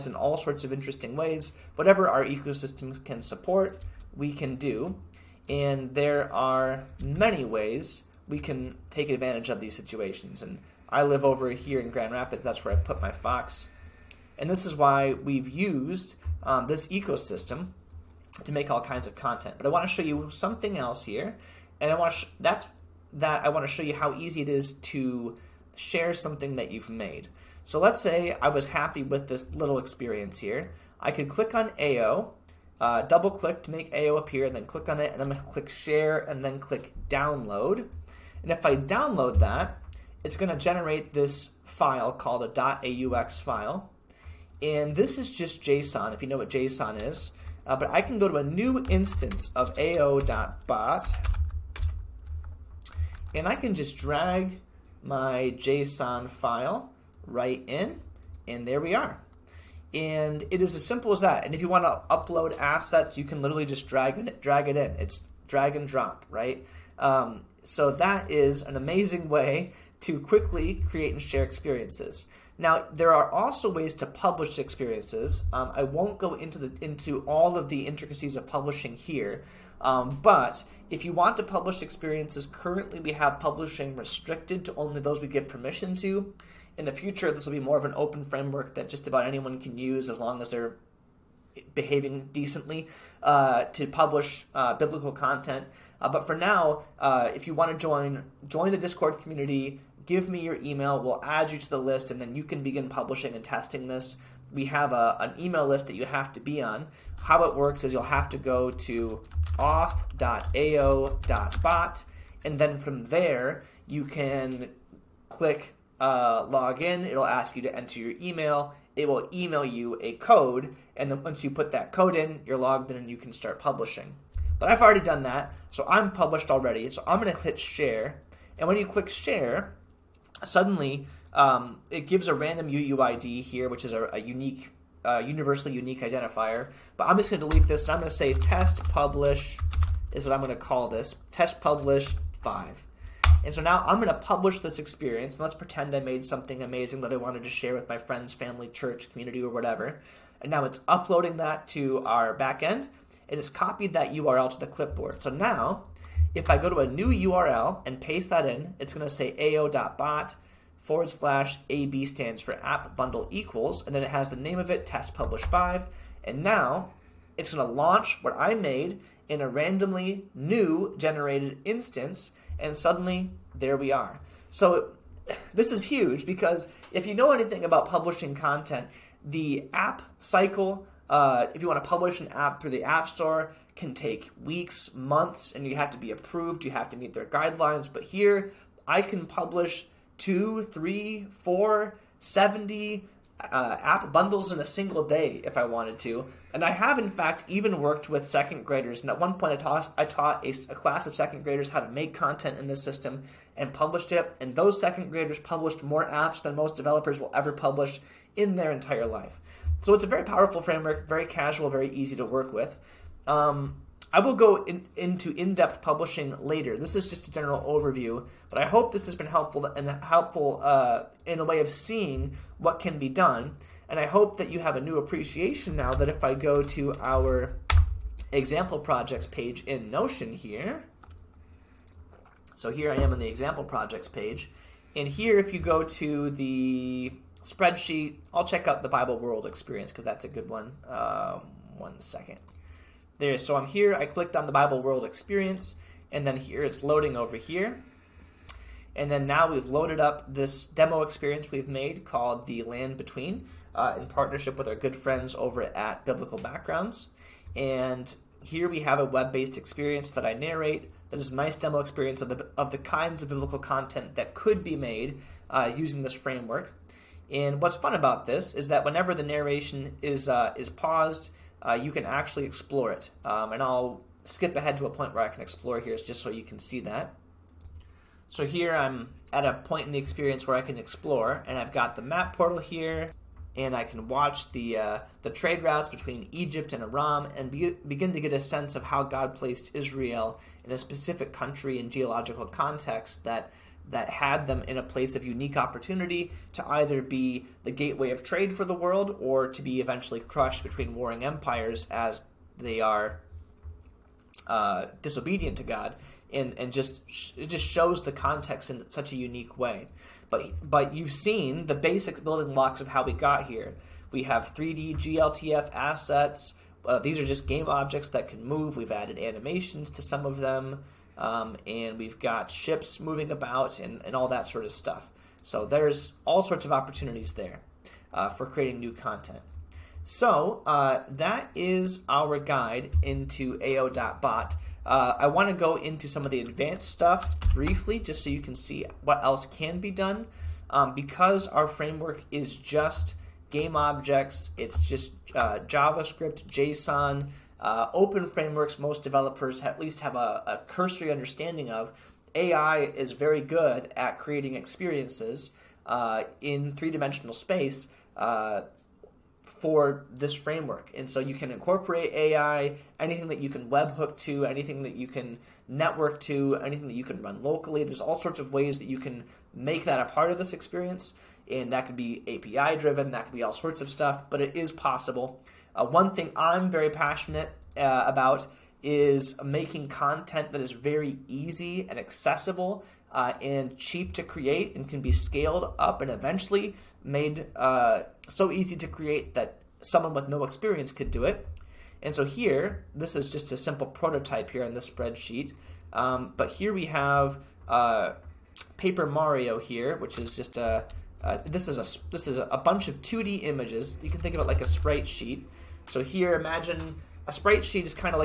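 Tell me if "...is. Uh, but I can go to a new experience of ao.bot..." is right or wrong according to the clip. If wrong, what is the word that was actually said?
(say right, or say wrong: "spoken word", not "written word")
wrong: "instance", not "experience".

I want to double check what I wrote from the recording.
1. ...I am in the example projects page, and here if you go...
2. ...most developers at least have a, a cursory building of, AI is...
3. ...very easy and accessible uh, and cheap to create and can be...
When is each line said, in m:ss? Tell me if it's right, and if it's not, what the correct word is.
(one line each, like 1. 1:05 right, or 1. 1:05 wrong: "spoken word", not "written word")
1. 3:52 right
2. 5:48 wrong: "understanding", not "building"
3. 6:20 right.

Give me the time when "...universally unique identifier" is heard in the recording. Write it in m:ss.
2:15.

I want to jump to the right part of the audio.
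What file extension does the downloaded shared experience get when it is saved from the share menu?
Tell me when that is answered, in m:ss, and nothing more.
0:42.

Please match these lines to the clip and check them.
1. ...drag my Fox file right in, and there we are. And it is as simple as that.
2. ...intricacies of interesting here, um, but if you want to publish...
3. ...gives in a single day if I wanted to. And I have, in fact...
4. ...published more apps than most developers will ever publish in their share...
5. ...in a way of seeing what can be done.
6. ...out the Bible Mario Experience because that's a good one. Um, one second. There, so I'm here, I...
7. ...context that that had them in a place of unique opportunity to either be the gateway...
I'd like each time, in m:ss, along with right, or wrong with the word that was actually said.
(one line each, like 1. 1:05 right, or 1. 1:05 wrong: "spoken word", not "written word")
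1. 0:53 wrong: "JSON", not "Fox"
2. 1:17 wrong: "publishing", not "interesting"
3. 3:14 wrong: "bundles", not "gives"
4. 3:25 wrong: "entire", not "share"
5. 3:41 right
6. 3:58 wrong: "World", not "Mario"
7. 4:52 right.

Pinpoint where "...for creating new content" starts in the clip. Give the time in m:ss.
5:28.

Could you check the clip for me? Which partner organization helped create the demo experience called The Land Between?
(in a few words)
Biblical Backgrounds.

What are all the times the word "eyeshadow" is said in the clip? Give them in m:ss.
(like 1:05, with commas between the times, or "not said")
not said.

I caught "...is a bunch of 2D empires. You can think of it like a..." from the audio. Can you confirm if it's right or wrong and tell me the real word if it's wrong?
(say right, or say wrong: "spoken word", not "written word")
wrong: "images", not "empires".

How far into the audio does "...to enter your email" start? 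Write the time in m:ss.
1:57.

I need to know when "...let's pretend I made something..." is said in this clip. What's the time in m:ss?
2:25.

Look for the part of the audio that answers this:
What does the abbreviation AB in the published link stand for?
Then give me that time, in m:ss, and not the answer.
2:42.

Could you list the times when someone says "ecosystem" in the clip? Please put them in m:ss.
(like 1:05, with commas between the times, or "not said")
0:02, 0:16.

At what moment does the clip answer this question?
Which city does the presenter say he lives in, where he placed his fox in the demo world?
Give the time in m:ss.
0:11.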